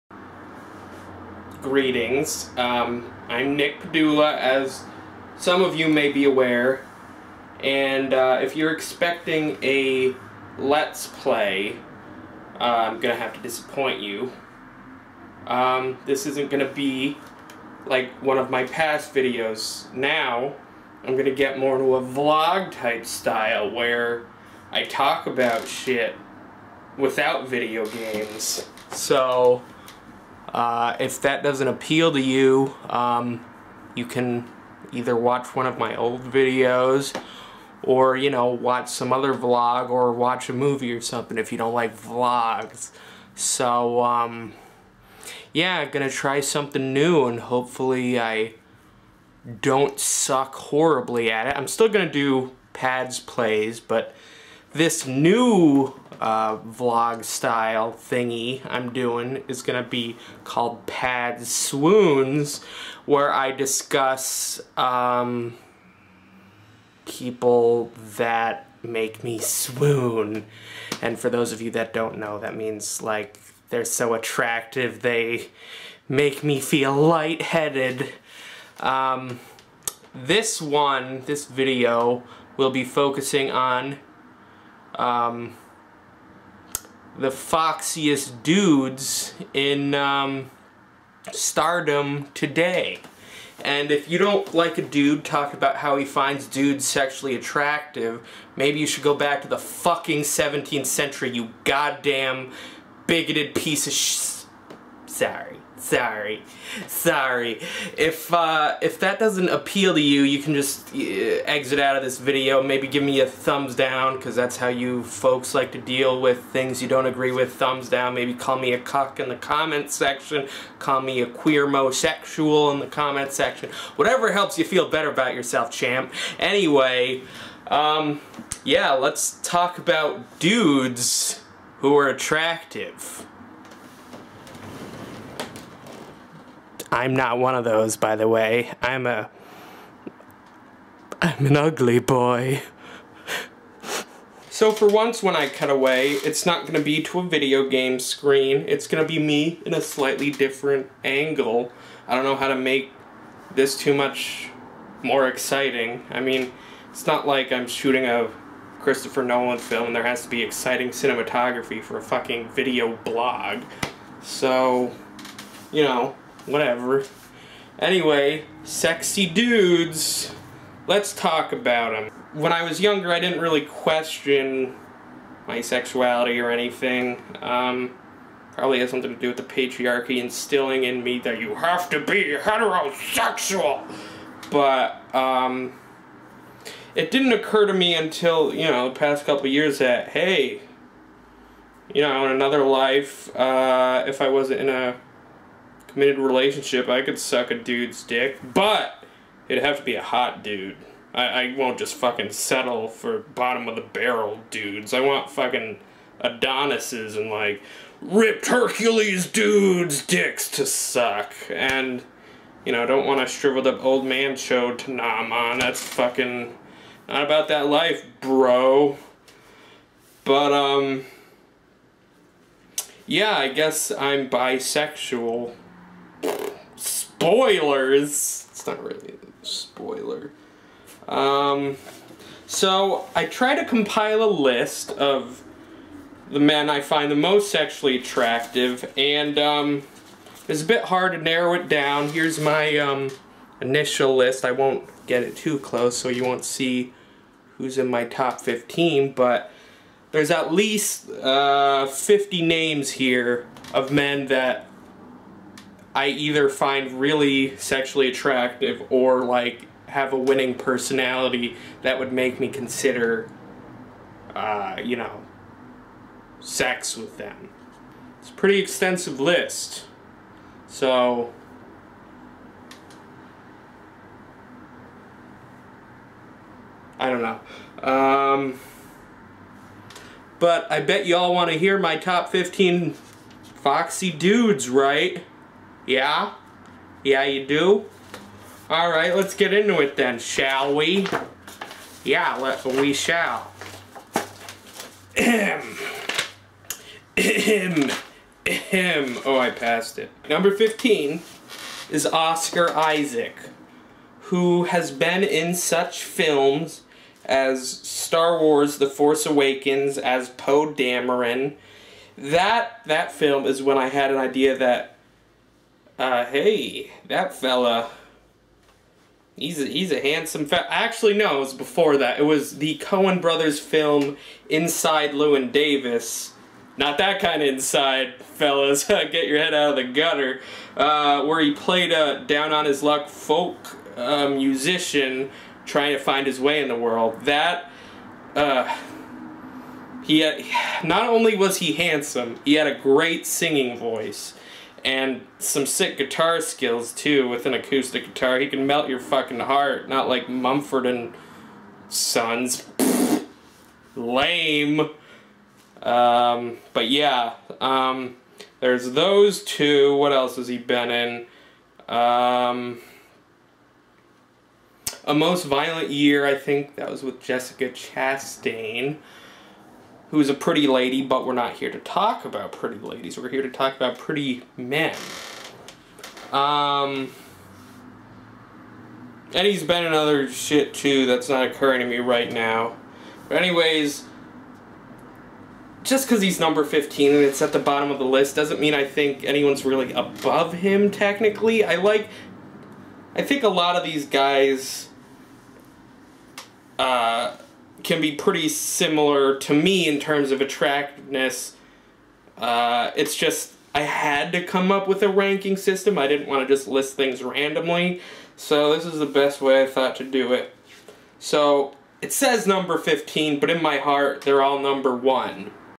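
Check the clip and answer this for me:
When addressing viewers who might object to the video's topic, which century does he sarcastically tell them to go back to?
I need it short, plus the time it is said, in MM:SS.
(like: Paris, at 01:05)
17th century, at 01:40.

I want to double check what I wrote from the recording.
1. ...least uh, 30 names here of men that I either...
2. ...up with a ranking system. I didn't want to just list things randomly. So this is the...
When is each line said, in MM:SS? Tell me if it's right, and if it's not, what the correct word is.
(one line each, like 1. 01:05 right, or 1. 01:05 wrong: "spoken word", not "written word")
1. 04:10 wrong: "50", not "30"
2. 06:44 right.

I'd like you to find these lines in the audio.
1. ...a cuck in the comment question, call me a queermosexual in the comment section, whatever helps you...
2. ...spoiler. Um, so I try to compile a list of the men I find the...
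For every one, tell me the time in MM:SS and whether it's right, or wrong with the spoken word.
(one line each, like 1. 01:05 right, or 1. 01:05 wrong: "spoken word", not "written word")
1. 01:58 wrong: "section", not "question"
2. 03:49 right.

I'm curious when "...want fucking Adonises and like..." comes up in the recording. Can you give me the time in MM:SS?
03:25.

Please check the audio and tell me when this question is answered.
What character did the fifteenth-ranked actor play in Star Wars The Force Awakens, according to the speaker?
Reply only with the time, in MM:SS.
05:10.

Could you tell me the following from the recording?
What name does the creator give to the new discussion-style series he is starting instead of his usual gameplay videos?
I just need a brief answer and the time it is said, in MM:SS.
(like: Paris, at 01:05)
Pad Swoons, at 01:00.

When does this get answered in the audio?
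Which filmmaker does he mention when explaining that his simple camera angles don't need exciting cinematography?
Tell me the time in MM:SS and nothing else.
02:38.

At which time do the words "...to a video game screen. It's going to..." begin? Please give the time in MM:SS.
02:27.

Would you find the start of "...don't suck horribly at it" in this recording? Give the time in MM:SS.
00:49.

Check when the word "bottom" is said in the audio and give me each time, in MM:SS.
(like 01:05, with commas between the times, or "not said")
03:23, 06:27.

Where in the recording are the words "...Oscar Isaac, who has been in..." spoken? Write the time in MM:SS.
05:02.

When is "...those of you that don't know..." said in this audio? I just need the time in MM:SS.
01:11.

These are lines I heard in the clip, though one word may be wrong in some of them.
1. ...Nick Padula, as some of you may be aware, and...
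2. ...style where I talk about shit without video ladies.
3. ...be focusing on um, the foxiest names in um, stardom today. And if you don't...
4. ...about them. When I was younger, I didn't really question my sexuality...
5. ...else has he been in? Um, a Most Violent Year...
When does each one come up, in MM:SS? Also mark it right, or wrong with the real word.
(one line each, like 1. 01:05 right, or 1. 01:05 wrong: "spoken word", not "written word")
1. 00:03 right
2. 00:23 wrong: "games", not "ladies"
3. 01:22 wrong: "dudes", not "names"
4. 02:51 right
5. 06:00 right.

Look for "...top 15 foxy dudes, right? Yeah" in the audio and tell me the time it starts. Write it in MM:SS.
04:41.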